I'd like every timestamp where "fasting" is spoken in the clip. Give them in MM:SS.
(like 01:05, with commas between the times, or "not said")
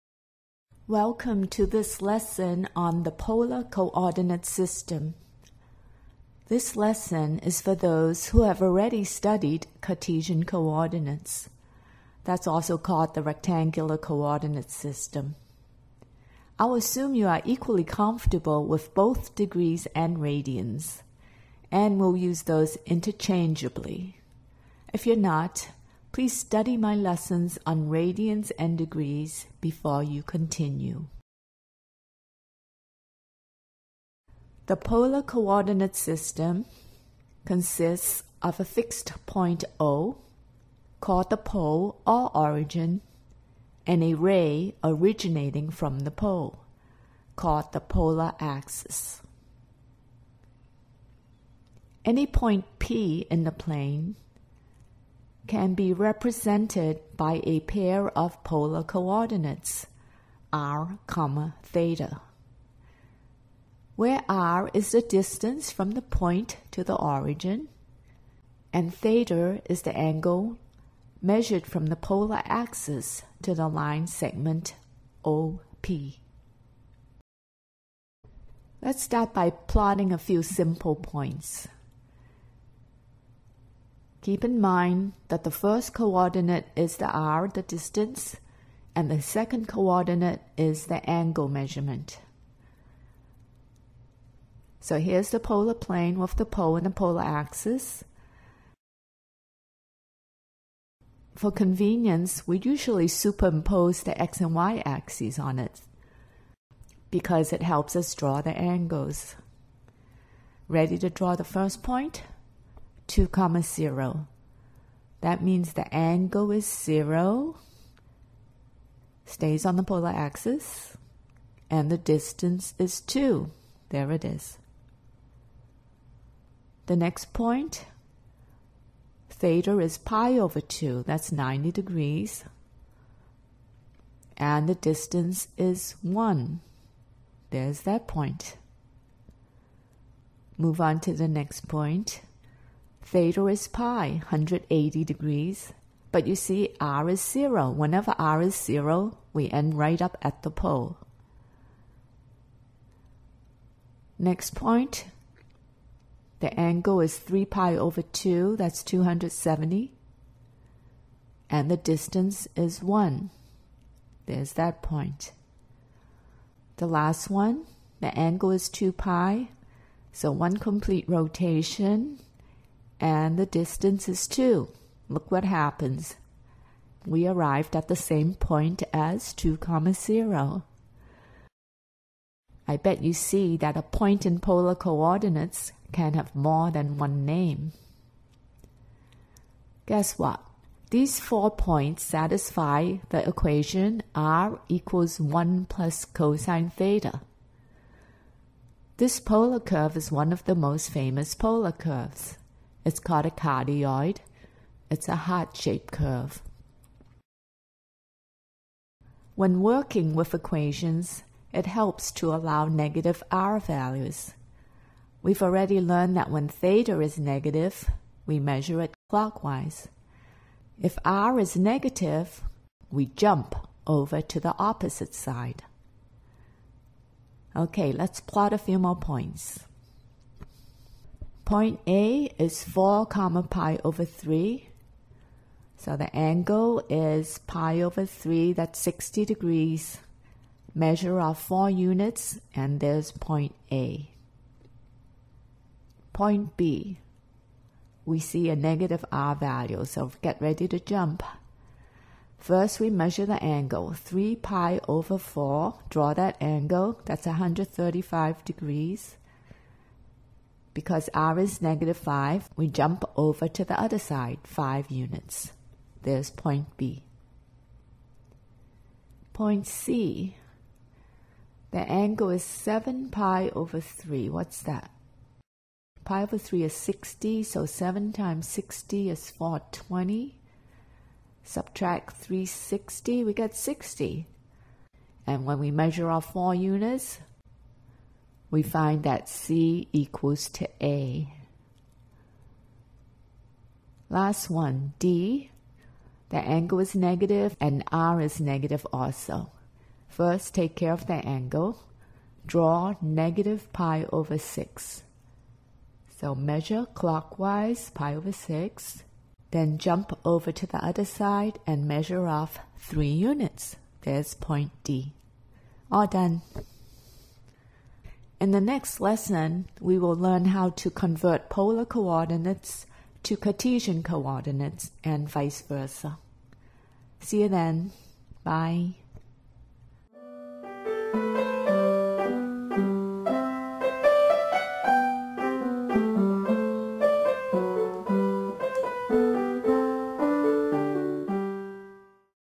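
not said.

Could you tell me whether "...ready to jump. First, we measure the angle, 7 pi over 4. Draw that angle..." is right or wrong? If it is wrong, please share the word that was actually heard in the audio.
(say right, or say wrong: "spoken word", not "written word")
wrong: "3", not "7".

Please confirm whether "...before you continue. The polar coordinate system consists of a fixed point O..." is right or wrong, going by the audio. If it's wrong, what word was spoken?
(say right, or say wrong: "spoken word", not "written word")
right.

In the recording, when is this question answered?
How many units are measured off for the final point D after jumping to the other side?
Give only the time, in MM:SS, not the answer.
05:12.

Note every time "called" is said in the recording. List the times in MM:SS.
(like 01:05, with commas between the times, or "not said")
00:12, 00:40, 00:47, 03:22.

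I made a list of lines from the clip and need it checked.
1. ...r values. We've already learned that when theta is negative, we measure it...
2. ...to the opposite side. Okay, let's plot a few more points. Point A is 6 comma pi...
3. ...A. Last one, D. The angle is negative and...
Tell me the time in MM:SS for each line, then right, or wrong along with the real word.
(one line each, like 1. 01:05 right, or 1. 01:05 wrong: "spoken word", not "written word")
1. 03:33 right
2. 03:44 wrong: "4", not "6"
3. 04:50 right.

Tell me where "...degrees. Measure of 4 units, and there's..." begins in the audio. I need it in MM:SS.
03:59.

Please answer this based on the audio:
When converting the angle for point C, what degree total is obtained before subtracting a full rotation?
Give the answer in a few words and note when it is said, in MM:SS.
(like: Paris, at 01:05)
420, at 04:39.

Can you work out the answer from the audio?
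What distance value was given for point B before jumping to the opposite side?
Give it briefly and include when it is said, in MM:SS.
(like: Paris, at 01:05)
-5, at 04:21.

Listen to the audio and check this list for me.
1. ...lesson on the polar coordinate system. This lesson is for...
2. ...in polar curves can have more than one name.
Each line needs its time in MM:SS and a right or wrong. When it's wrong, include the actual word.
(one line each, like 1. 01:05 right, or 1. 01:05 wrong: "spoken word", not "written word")
1. 00:02 right
2. 03:04 wrong: "coordinates", not "curves".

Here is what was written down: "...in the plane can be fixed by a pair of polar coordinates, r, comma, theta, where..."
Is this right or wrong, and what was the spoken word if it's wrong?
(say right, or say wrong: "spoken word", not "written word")
wrong: "represented", not "fixed".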